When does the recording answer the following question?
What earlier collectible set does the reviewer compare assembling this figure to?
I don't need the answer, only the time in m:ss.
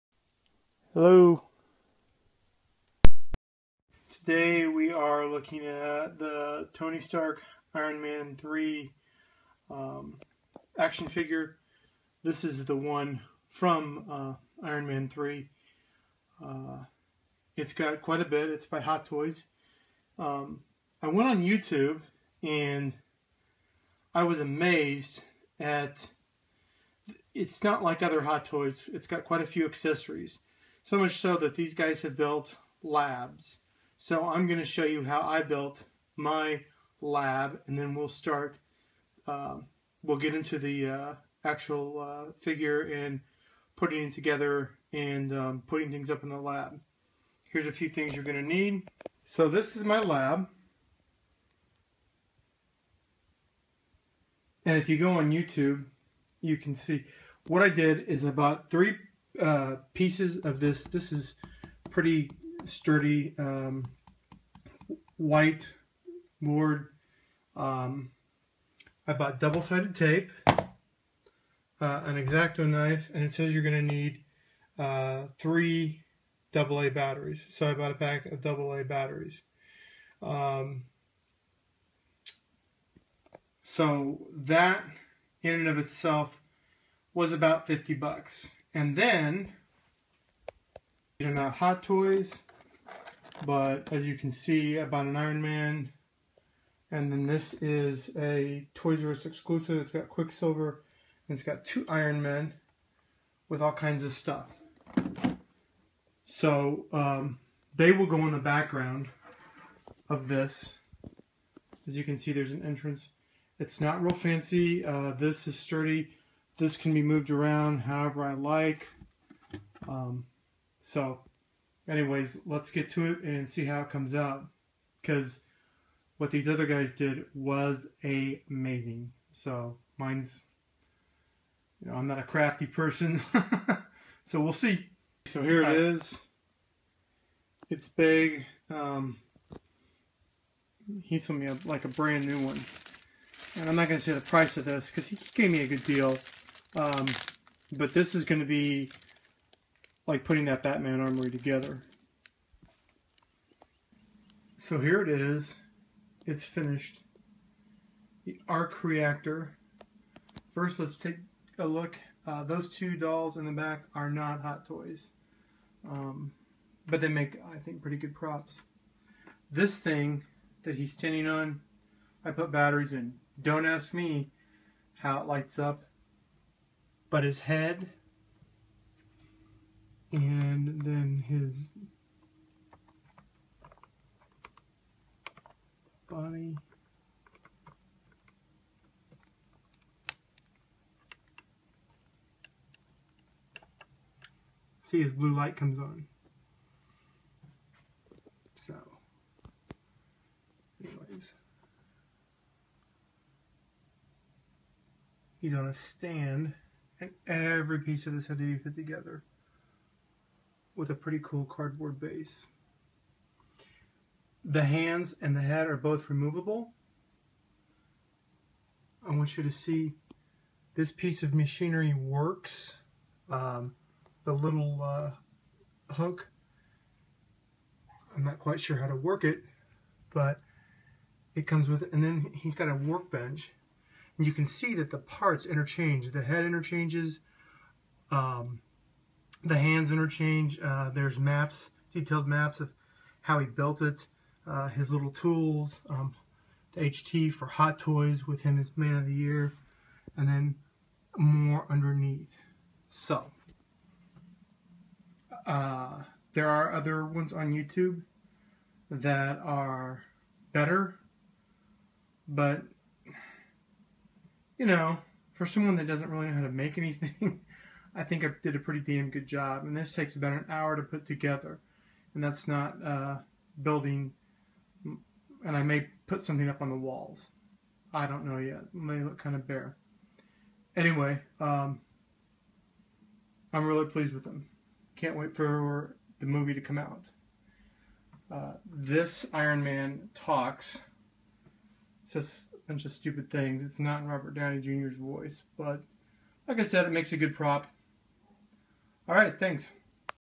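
2:30.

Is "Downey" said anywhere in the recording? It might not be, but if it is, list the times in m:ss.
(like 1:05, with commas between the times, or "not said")
4:54.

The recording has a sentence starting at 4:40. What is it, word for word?
Anyway, um, I'm really pleased with them.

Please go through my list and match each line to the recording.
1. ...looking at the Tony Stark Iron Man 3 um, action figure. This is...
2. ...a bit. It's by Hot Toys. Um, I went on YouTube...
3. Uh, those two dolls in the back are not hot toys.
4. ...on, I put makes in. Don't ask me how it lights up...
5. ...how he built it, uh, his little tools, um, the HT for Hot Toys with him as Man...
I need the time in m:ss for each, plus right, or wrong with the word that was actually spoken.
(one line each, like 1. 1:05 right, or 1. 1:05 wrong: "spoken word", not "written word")
1. 0:05 right
2. 0:18 right
3. 2:42 right
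4. 2:51 wrong: "batteries", not "makes"
5. 4:03 right.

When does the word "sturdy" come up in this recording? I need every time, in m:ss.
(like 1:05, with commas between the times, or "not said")
1:02, 1:55.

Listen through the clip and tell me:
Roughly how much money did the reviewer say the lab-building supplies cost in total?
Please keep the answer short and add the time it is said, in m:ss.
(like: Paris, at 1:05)
50 bucks, at 1:27.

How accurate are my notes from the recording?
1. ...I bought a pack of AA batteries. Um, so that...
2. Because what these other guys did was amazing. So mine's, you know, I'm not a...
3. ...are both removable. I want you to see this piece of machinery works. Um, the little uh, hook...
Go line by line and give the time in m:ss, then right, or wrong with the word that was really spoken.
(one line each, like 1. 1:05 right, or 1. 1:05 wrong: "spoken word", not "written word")
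1. 1:17 right
2. 2:05 right
3. 3:35 right.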